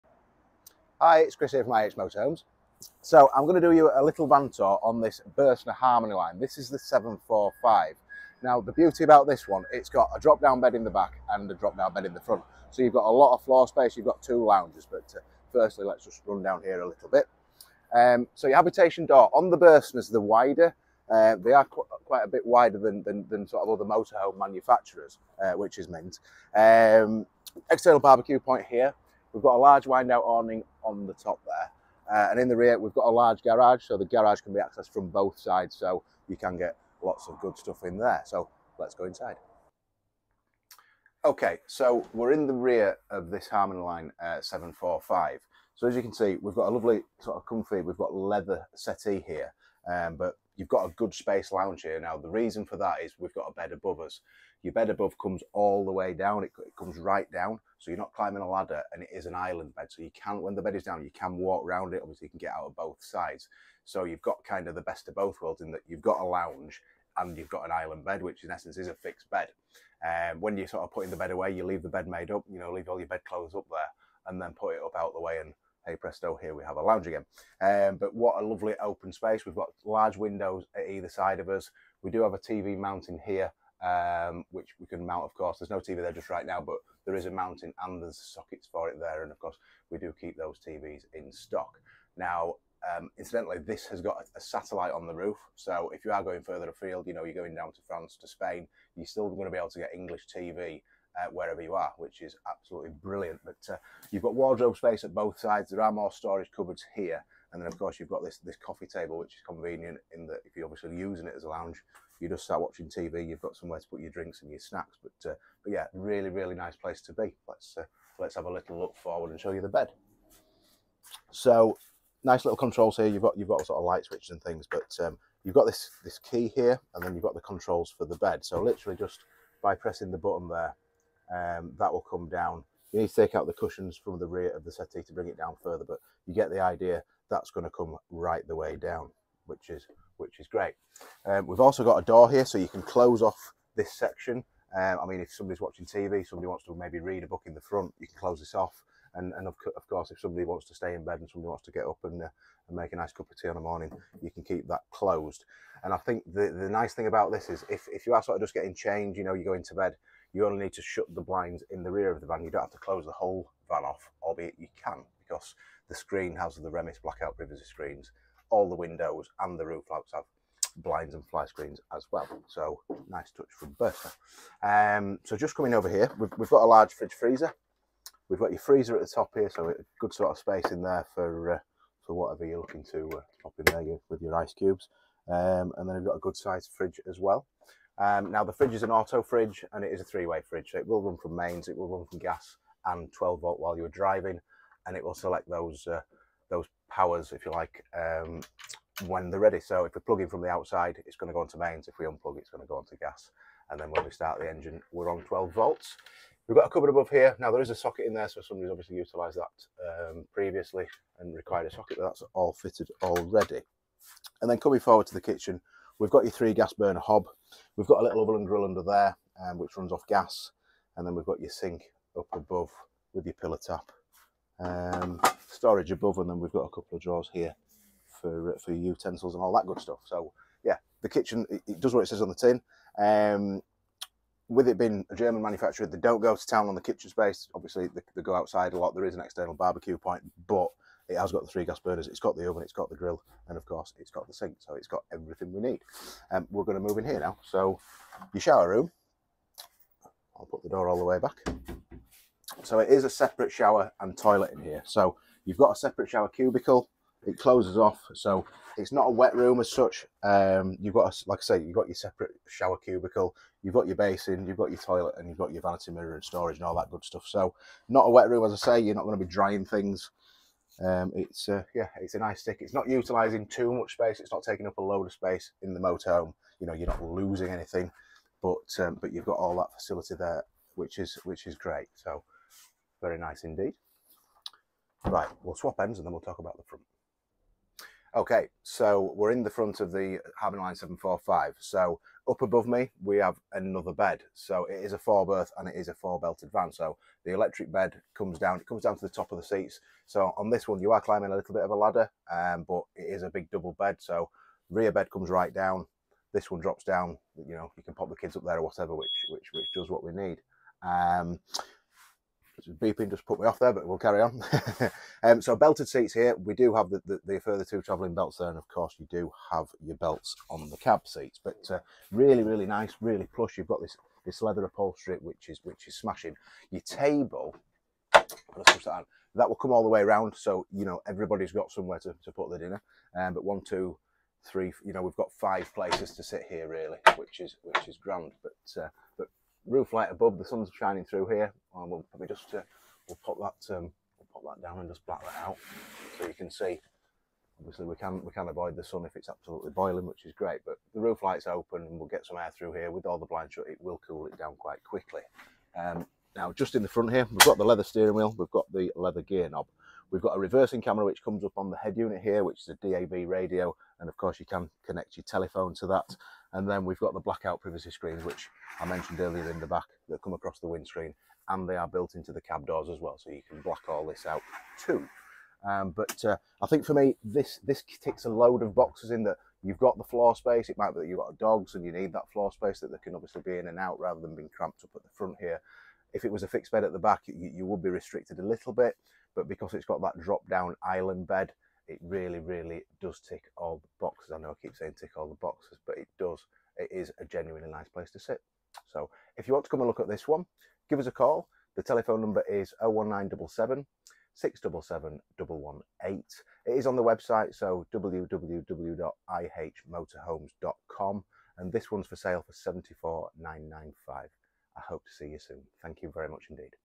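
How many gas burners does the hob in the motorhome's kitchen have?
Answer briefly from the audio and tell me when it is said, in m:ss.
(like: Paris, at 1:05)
3, at 3:36.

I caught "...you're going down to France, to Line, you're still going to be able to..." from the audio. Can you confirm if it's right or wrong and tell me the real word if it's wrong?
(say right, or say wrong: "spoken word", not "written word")
wrong: "Spain", not "Line".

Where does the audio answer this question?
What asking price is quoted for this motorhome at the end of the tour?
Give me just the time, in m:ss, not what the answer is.
6:52.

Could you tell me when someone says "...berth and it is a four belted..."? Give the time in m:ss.
4:55.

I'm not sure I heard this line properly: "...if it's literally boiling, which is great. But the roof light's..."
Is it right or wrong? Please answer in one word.
wrong.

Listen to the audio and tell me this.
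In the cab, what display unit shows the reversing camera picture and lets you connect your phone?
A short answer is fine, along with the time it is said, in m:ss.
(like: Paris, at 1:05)
DAB radio, at 6:02.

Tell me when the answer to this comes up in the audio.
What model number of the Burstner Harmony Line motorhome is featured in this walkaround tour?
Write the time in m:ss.
0:06.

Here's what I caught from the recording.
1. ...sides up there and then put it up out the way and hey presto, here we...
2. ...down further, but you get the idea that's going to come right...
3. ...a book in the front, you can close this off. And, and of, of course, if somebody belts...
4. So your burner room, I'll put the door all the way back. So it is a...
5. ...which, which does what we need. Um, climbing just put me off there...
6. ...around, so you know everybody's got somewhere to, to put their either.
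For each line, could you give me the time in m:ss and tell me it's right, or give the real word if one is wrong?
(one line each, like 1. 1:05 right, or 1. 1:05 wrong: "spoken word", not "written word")
1. 1:13 wrong: "clothes", not "sides"
2. 2:15 right
3. 2:27 wrong: "wants", not "belts"
4. 4:07 wrong: "shower", not "burner"
5. 5:09 wrong: "beeping", not "climbing"
6. 5:30 wrong: "dinner", not "either".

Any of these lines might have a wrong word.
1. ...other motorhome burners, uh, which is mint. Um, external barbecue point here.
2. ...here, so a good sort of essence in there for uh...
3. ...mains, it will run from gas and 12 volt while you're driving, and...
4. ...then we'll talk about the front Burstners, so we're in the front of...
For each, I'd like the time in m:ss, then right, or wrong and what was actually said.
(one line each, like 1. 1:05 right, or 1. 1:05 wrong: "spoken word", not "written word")
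1. 0:23 wrong: "manufacturers", not "burners"
2. 2:59 wrong: "space", not "essence"
3. 3:11 right
4. 4:46 wrong: "Okay", not "Burstners".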